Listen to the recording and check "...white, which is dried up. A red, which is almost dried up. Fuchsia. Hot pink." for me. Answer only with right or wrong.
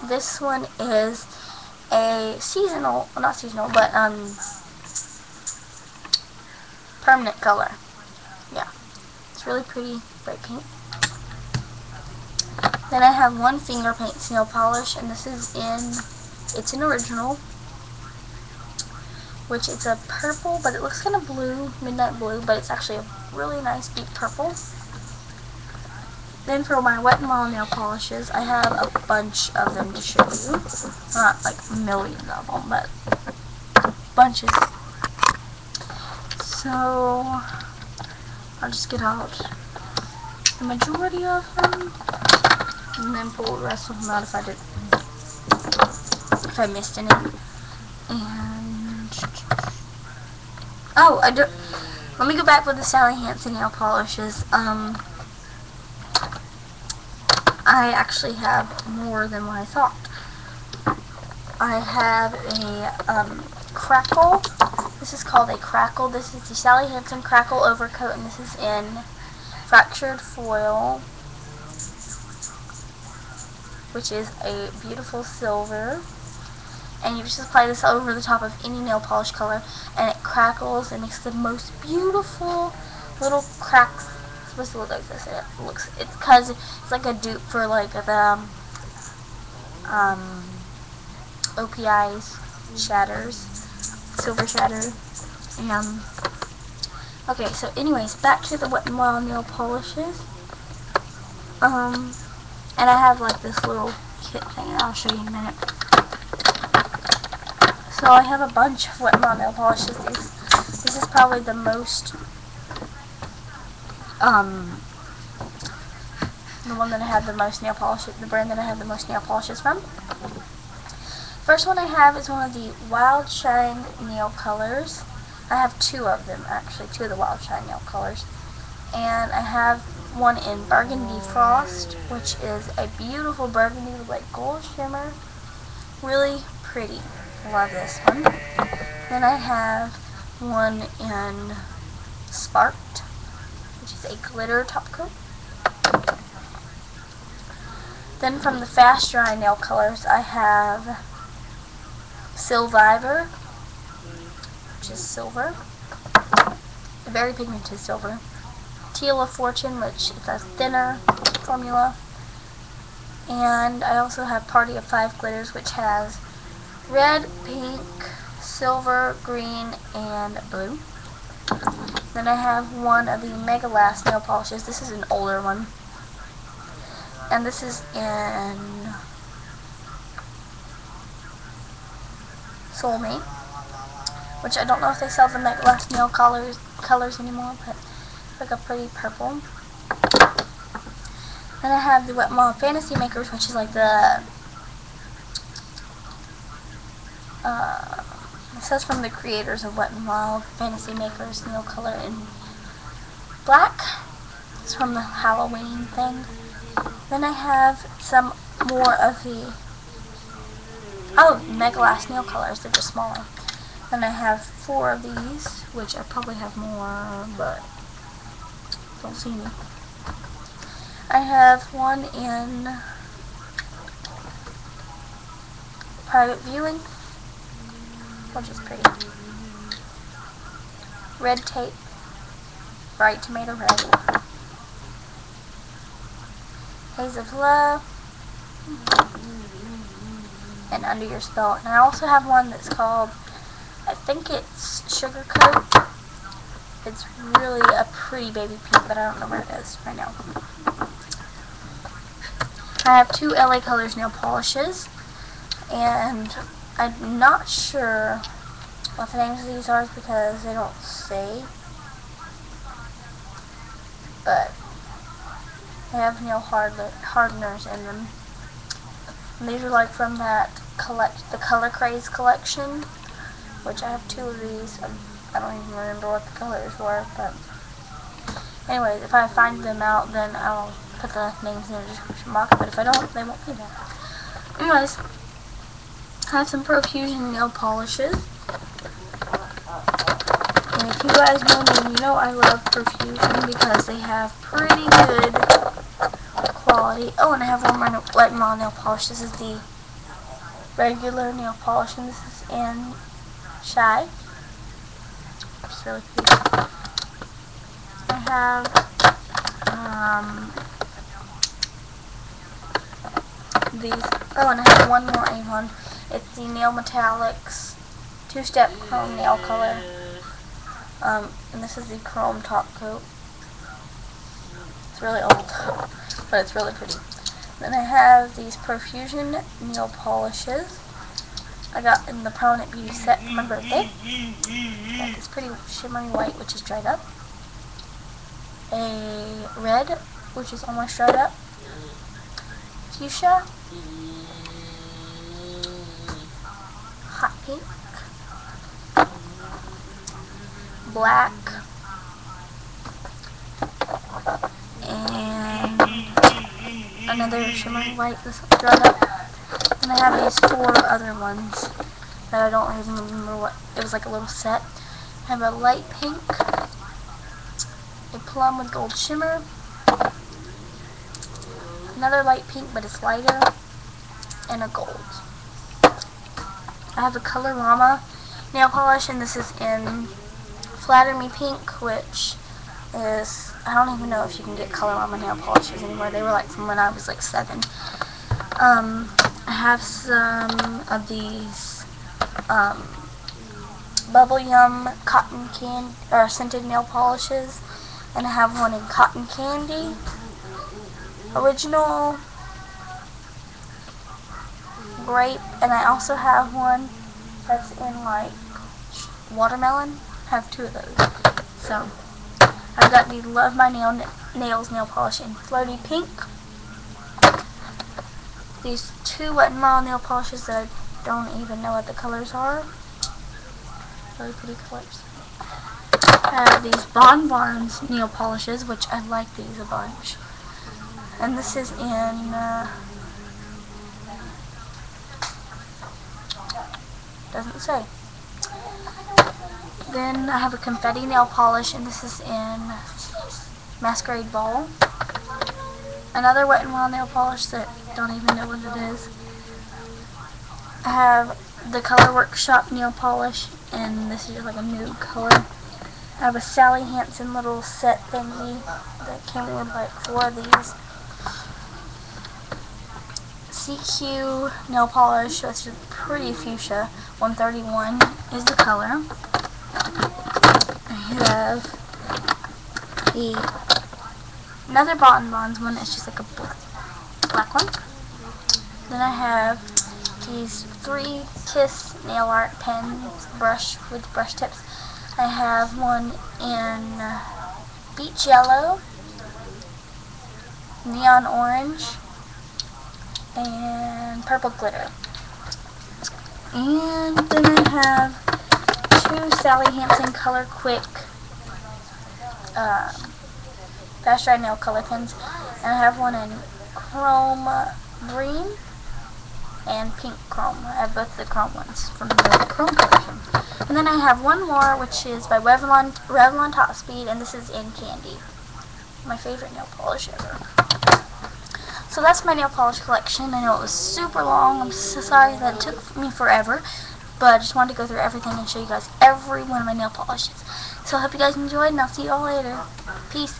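right.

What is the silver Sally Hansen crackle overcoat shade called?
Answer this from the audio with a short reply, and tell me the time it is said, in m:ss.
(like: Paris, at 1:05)
Fractured Foil, at 1:09.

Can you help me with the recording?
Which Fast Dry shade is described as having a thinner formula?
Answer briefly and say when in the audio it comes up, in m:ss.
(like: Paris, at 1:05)
Teal of Fortune, at 2:38.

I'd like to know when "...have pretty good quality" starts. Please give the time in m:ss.
4:53.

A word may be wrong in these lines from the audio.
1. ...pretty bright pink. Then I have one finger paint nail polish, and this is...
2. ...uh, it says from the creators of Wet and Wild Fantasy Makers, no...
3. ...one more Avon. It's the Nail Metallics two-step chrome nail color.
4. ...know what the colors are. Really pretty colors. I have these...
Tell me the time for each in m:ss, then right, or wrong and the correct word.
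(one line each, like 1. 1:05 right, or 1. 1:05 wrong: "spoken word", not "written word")
1. 0:09 right
2. 3:17 right
3. 5:14 right
4. 7:01 right.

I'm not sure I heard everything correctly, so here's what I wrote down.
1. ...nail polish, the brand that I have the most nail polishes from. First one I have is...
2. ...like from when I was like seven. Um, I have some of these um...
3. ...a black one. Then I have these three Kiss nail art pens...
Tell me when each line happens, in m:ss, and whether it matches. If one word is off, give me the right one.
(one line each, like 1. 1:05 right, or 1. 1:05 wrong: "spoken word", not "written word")
1. 1:57 right
2. 6:26 right
3. 7:56 right.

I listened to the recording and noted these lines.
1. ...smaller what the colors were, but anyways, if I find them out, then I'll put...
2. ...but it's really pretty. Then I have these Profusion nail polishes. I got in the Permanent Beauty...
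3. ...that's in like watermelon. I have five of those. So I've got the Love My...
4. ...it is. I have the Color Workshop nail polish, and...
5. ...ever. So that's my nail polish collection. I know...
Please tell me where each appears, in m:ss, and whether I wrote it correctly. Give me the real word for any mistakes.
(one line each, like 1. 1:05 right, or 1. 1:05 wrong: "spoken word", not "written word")
1. 4:35 wrong: "remember", not "smaller"
2. 5:26 right
3. 6:47 wrong: "two", not "five"
4. 7:28 right
5. 8:40 right.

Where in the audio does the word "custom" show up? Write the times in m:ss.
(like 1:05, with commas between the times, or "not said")
not said.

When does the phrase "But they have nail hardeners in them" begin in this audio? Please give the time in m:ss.
4:24.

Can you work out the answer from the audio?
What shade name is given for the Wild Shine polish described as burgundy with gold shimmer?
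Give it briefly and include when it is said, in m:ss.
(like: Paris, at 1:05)
Burgundy Frost, at 2:10.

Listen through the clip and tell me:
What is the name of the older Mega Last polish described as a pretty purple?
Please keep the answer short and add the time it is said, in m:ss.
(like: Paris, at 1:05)
Soulmate, at 3:02.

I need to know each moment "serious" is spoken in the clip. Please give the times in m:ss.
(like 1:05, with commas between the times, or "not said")
not said.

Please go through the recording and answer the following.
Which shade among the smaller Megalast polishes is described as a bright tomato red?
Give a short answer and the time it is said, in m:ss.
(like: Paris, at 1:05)
Red Tape, at 3:51.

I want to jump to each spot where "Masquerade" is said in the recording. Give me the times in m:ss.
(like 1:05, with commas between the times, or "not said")
7:23.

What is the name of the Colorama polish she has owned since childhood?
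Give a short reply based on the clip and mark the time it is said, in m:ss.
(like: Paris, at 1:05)
Flatter Me Pink, at 6:20.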